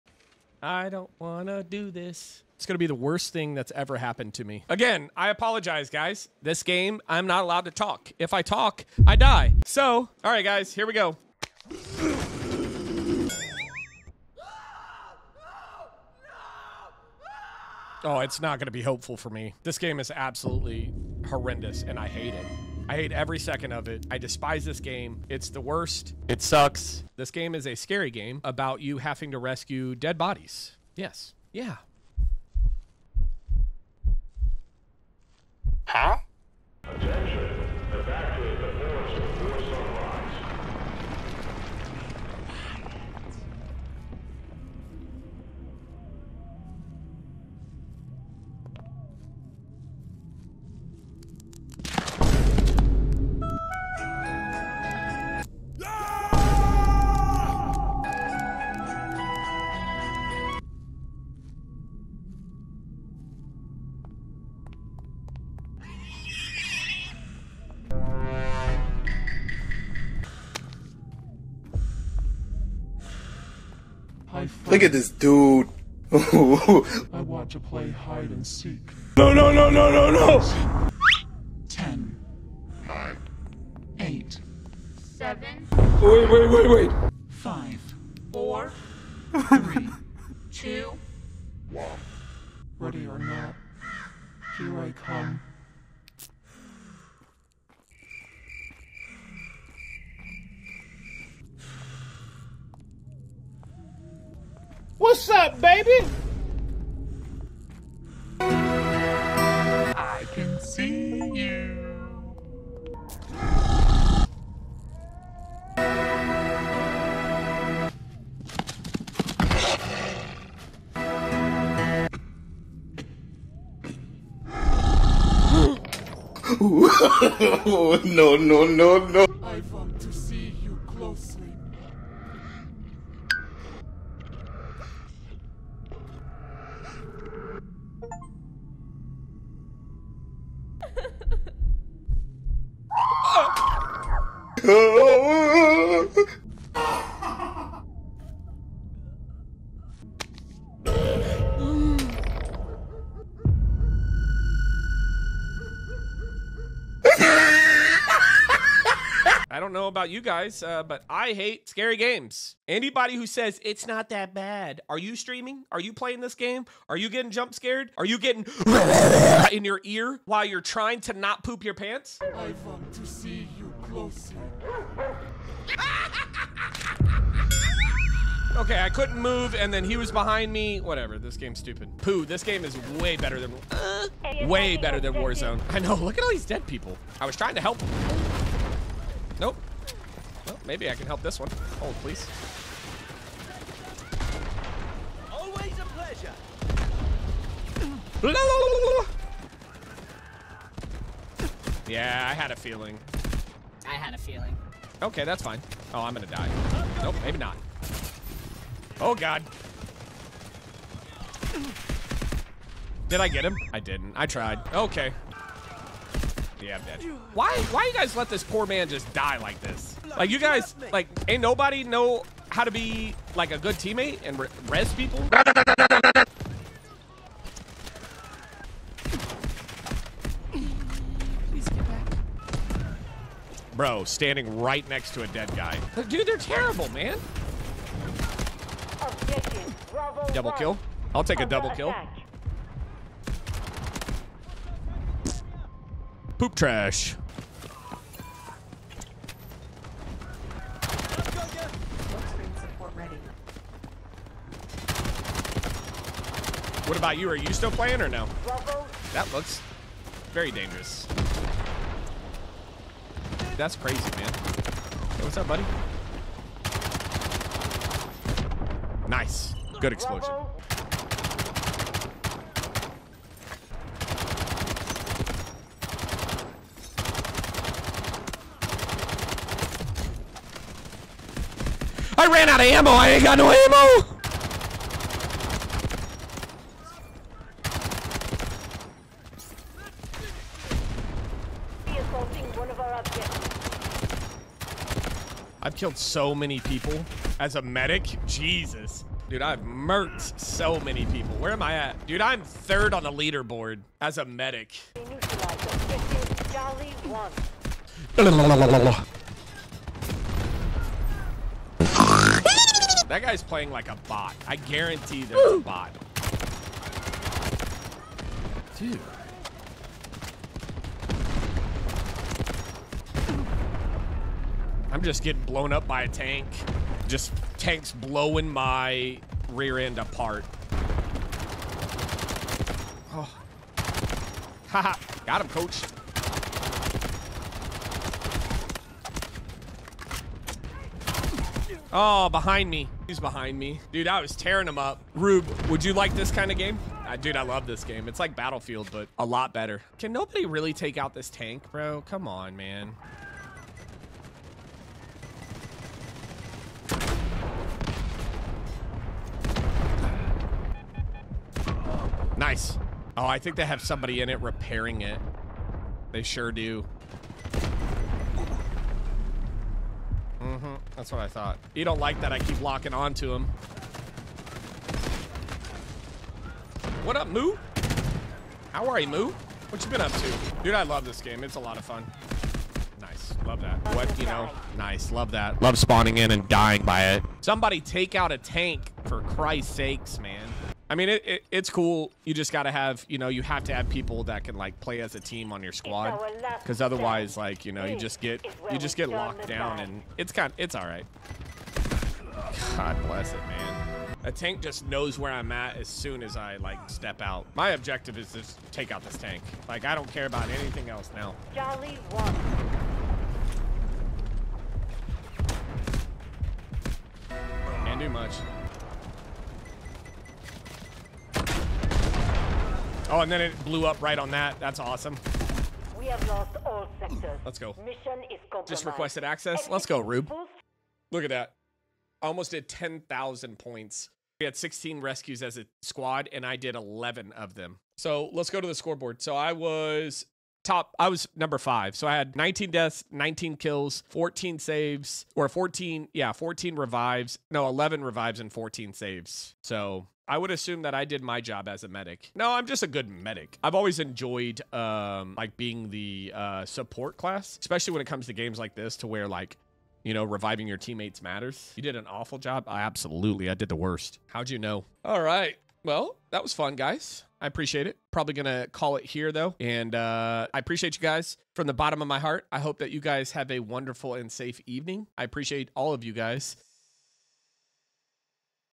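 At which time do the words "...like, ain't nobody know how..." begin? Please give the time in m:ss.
3:40.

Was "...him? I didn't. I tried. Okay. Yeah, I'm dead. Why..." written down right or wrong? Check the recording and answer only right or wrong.
right.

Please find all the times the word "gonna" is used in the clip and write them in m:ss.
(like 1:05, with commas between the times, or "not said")
3:26.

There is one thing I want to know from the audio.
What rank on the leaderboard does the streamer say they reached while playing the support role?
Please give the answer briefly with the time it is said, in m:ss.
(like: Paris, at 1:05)
third, at 5:02.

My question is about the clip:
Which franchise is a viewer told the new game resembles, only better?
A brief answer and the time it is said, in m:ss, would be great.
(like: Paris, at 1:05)
Battlefield, at 5:48.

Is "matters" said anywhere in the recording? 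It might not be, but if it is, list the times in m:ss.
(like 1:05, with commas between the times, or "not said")
7:41.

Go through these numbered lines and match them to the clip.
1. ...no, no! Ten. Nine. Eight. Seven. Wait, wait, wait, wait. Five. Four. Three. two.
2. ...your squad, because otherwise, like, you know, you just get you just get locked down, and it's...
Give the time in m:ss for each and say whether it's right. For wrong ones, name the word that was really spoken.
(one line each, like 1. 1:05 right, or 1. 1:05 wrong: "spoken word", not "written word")
1. 1:19 right
2. 6:35 right.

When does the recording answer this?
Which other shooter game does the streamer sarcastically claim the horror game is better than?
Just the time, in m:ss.
3:05.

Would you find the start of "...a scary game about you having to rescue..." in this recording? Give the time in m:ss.
0:27.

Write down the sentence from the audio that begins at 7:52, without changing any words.
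I hope that you guys have a wonderful and safe evening.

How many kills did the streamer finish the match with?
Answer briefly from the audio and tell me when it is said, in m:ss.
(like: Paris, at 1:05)
19, at 7:23.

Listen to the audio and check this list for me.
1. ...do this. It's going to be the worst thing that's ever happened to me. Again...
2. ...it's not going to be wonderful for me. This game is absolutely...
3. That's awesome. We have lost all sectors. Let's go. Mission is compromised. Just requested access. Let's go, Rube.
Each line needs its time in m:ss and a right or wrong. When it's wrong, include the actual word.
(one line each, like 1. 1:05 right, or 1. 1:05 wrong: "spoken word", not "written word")
1. 0:01 right
2. 0:18 wrong: "helpful", not "wonderful"
3. 7:04 right.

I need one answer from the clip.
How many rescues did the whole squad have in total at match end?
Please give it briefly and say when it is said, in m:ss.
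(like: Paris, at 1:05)
16, at 7:14.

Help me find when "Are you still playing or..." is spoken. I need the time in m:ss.
4:17.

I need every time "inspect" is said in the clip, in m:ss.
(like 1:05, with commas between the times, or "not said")
not said.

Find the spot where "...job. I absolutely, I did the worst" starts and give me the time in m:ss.
7:42.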